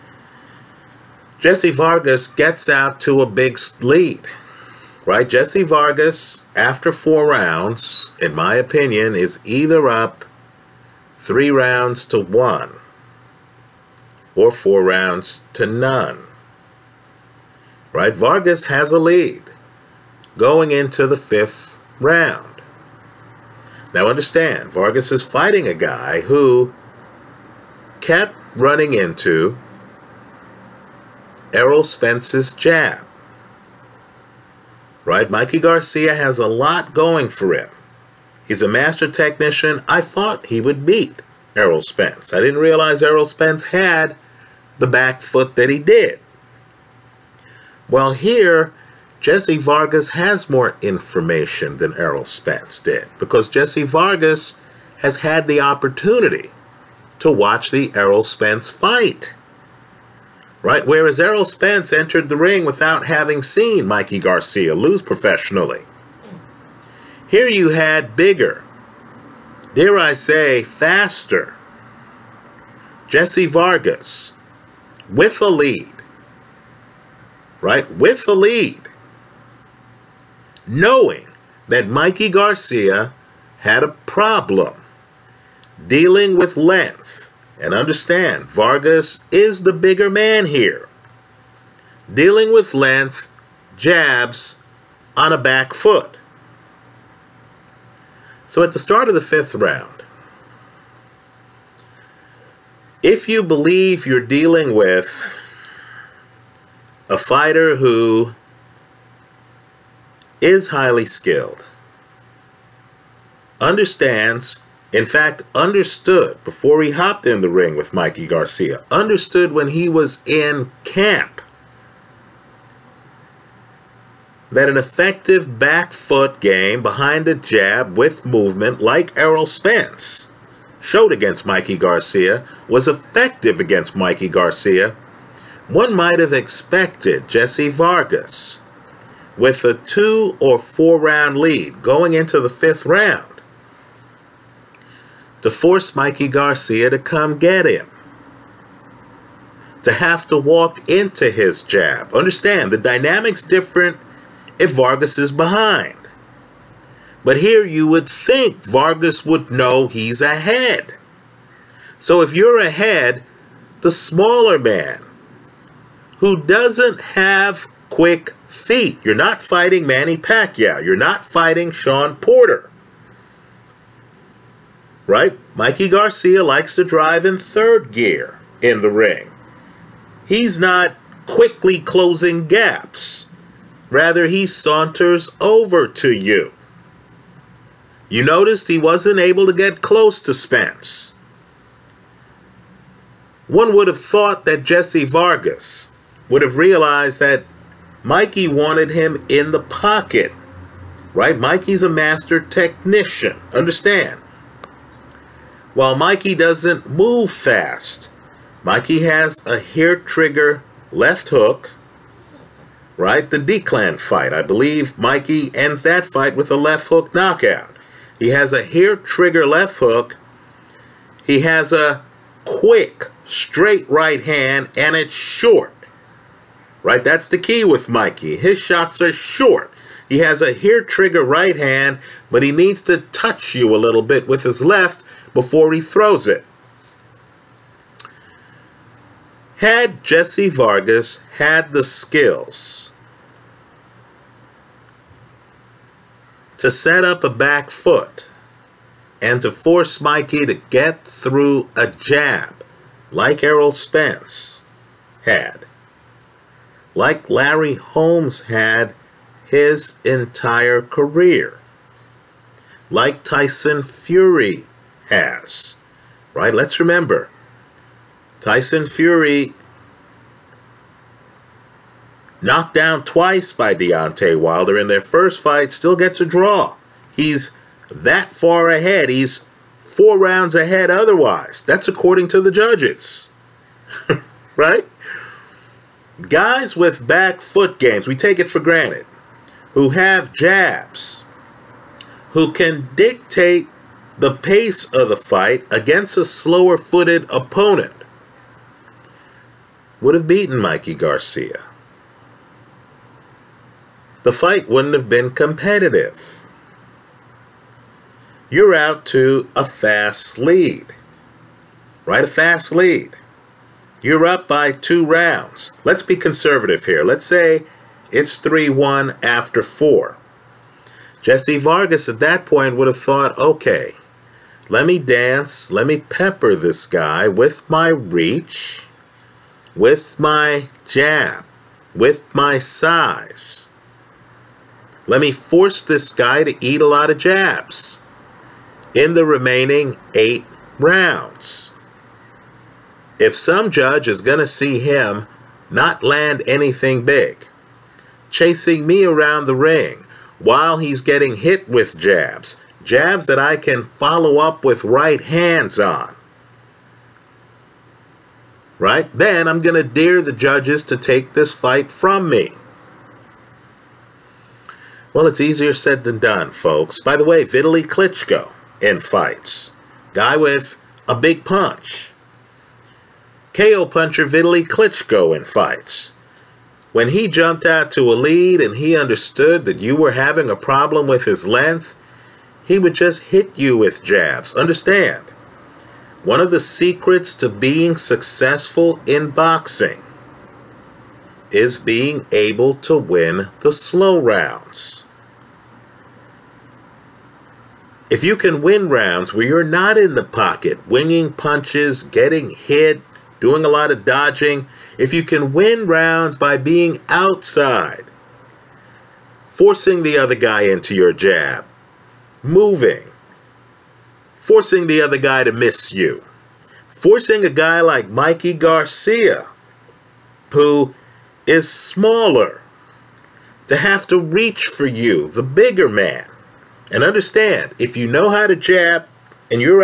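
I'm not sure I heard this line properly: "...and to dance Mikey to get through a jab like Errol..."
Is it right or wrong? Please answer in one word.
wrong.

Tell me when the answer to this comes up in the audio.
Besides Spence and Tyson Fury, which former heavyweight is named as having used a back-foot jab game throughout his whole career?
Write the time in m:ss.
4:17.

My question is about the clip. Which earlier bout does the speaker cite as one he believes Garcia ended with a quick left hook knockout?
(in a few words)
The D-Clan fight.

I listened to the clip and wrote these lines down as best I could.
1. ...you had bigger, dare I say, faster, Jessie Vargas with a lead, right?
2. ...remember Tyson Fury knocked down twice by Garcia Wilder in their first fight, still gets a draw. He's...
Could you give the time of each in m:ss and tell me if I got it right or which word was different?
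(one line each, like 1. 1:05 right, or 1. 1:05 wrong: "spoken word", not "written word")
1. 1:07 right
2. 4:26 wrong: "Deontay", not "Garcia".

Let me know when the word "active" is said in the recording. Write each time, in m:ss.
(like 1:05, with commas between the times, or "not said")
not said.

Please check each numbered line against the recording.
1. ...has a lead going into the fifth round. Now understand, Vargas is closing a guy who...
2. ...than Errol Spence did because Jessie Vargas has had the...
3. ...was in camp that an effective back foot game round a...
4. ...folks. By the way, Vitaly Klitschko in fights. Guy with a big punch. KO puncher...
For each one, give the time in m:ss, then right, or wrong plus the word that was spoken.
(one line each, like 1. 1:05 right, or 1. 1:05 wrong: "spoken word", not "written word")
1. 0:18 wrong: "fighting", not "closing"
2. 0:51 right
3. 1:59 wrong: "behind", not "round"
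4. 6:06 right.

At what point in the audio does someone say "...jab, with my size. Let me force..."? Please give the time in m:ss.
5:30.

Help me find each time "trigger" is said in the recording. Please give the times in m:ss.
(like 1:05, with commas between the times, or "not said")
3:29, 3:38, 3:50.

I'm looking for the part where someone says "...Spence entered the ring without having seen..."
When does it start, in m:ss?
1:01.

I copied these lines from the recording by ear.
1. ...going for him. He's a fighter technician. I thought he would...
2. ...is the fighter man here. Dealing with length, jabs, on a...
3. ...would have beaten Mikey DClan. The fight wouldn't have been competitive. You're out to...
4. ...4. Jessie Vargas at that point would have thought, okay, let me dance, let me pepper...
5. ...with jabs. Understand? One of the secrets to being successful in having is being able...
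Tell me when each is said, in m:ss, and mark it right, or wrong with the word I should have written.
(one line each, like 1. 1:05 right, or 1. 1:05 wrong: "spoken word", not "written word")
1. 0:36 wrong: "master", not "fighter"
2. 1:29 wrong: "bigger", not "fighter"
3. 5:00 wrong: "Garcia", not "DClan"
4. 5:19 right
5. 6:23 wrong: "boxing", not "having".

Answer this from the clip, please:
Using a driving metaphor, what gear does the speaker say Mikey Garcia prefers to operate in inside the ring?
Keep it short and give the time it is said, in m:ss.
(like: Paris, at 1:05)
Third gear, at 2:57.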